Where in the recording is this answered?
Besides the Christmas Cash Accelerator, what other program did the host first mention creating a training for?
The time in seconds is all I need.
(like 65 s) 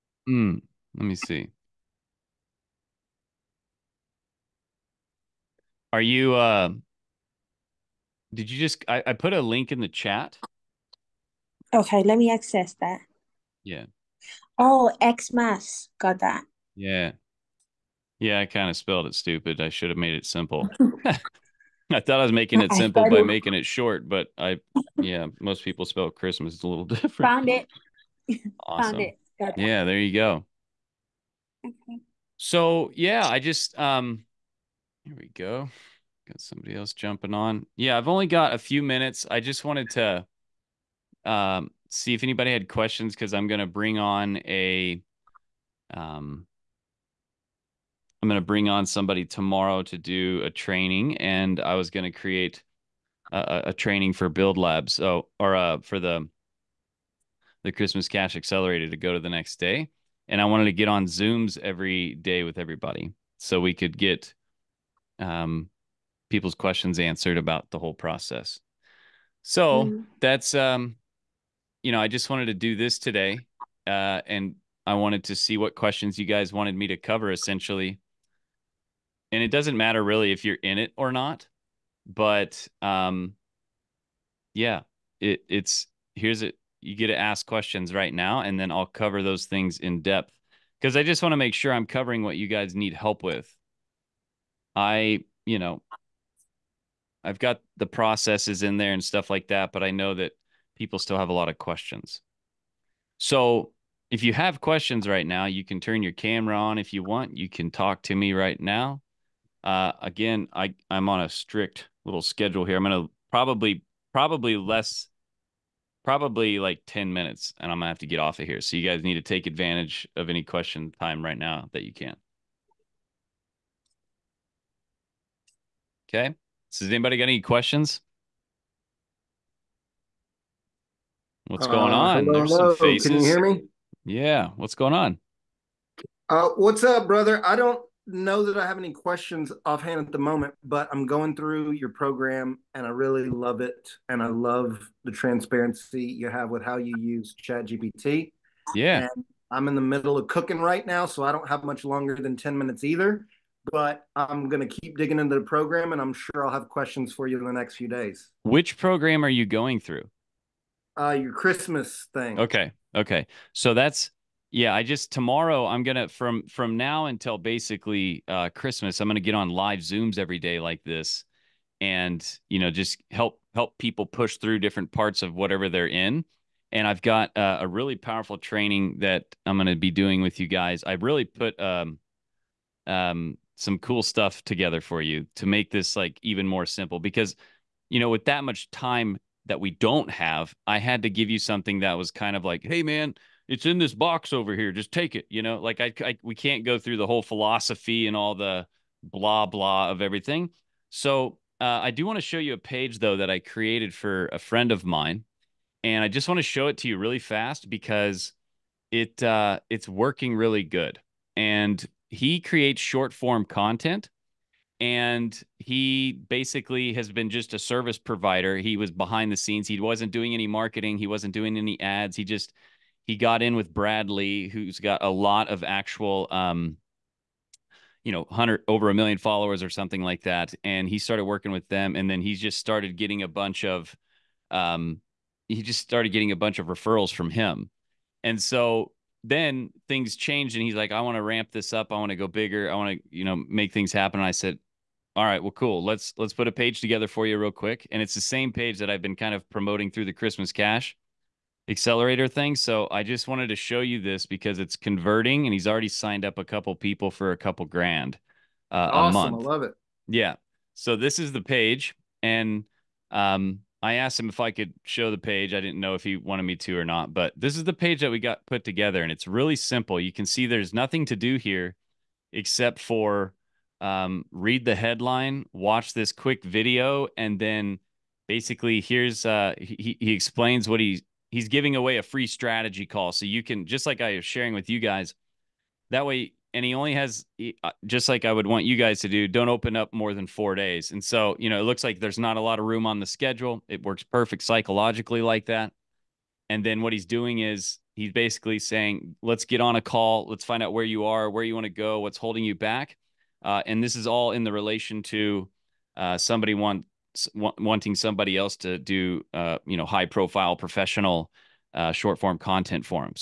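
54 s.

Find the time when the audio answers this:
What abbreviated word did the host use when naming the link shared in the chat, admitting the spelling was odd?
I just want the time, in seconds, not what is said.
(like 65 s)
15 s.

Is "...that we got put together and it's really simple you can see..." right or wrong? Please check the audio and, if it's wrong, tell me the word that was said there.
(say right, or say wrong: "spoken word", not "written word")
right.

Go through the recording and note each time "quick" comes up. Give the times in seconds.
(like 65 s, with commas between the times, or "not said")
247 s, 276 s.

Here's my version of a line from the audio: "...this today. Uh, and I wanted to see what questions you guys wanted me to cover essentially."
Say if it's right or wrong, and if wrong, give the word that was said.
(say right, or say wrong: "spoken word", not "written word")
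right.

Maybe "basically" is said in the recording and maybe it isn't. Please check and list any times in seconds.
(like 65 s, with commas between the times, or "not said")
167 s, 216 s, 278 s, 298 s.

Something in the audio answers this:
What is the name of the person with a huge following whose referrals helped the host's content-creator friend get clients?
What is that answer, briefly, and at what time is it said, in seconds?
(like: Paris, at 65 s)
Bradley, at 223 s.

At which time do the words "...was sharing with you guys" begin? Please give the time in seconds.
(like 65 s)
284 s.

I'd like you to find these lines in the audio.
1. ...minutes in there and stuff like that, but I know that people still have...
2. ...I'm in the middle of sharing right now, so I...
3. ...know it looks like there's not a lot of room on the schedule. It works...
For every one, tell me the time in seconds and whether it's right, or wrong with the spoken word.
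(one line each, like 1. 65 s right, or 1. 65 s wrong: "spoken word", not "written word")
1. 97 s wrong: "processes", not "minutes"
2. 149 s wrong: "cooking", not "sharing"
3. 291 s right.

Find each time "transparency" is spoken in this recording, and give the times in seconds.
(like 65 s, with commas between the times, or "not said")
145 s.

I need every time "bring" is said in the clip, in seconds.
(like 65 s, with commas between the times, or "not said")
43 s, 48 s.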